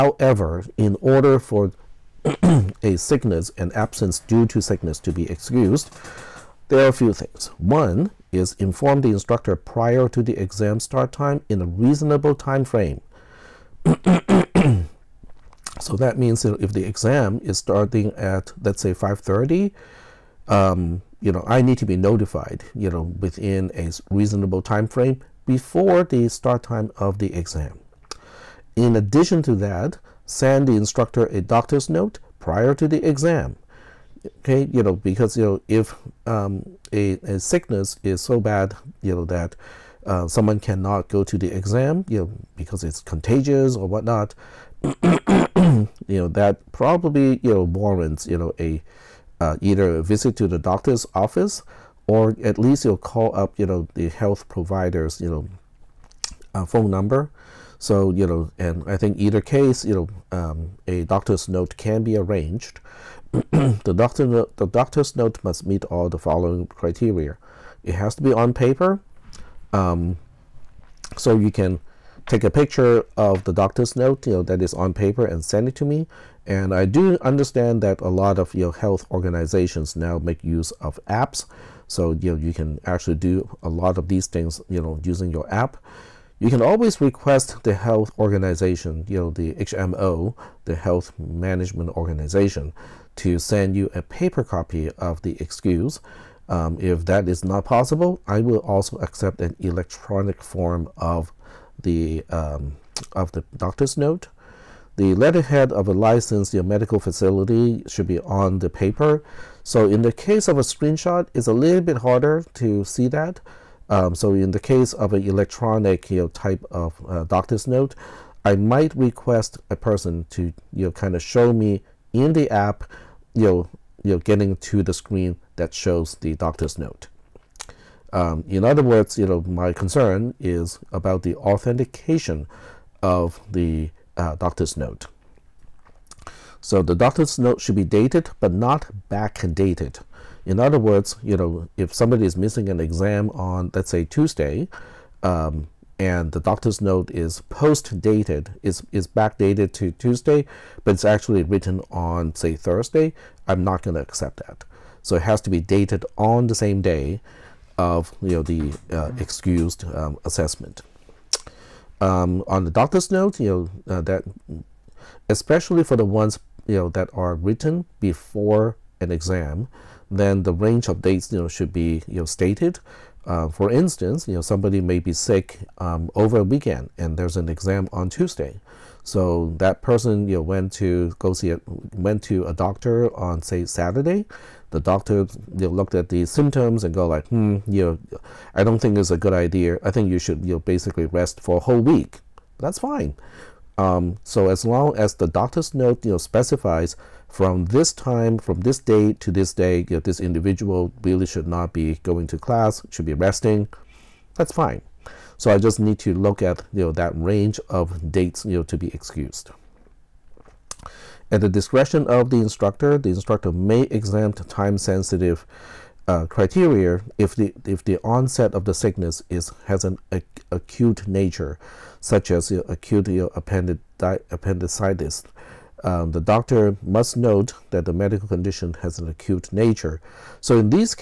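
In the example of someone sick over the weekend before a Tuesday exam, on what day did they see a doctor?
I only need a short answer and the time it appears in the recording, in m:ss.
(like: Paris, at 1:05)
Saturday, at 3:03.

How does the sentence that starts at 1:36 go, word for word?
Um, if that is not possible, I will also accept an electronic form of the um, of the doctor's note.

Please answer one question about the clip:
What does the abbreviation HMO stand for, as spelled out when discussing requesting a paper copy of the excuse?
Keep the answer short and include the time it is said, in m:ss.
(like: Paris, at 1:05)
Health Management Organization, at 1:30.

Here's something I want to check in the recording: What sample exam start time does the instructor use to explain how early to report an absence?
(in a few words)
5:30.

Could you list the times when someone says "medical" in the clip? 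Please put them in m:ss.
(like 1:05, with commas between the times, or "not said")
1:46, 3:47.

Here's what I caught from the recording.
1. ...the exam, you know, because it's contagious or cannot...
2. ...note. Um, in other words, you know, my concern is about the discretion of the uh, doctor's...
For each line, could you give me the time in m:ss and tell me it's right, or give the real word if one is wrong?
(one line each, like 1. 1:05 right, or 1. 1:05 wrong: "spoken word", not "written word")
1. 0:41 wrong: "whatnot", not "cannot"
2. 2:06 wrong: "authentication", not "discretion".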